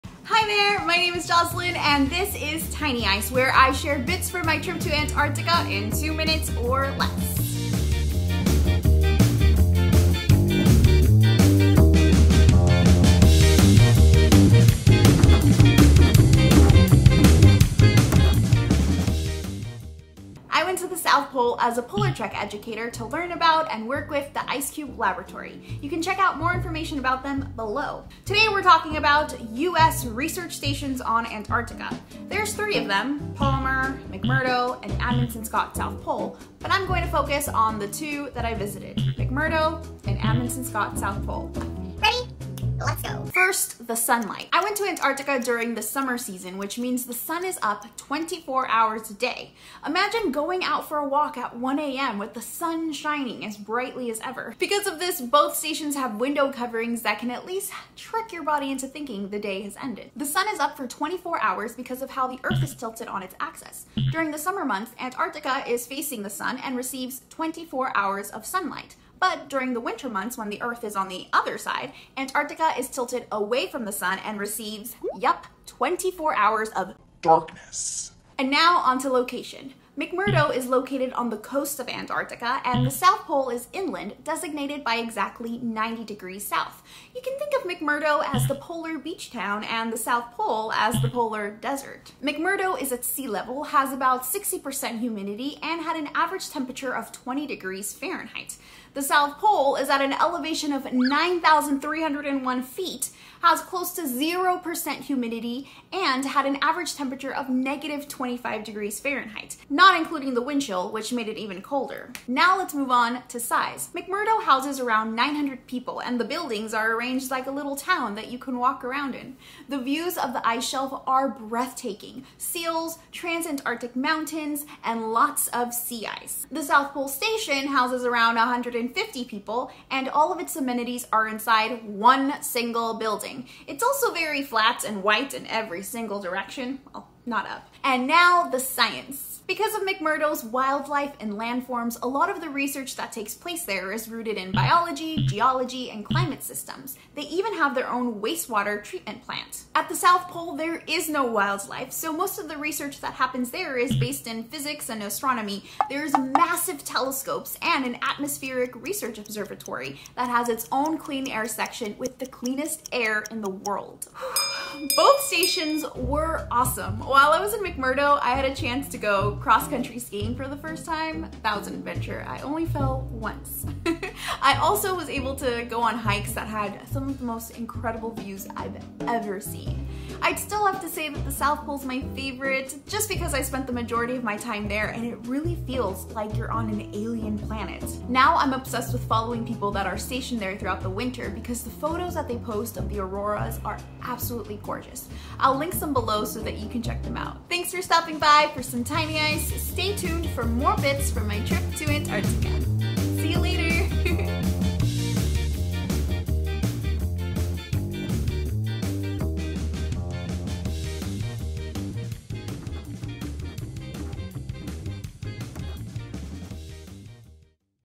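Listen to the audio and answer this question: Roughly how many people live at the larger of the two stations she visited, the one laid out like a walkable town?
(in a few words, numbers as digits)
900.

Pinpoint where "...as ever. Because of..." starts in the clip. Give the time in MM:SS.
00:54.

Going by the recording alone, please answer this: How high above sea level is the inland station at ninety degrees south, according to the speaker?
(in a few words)
9,301 feet.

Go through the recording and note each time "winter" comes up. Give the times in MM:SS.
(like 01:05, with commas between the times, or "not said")
01:09, 03:10.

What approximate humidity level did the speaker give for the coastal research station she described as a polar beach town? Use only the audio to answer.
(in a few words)
60%.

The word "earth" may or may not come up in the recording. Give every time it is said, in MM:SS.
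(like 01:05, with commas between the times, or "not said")
01:02, 01:10.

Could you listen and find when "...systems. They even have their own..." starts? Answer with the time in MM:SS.
02:26.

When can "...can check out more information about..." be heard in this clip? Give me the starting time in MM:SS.
00:25.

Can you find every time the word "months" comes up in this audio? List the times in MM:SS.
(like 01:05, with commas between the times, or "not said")
01:04, 01:10.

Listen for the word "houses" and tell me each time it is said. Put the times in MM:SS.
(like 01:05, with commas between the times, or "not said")
01:54, 02:07.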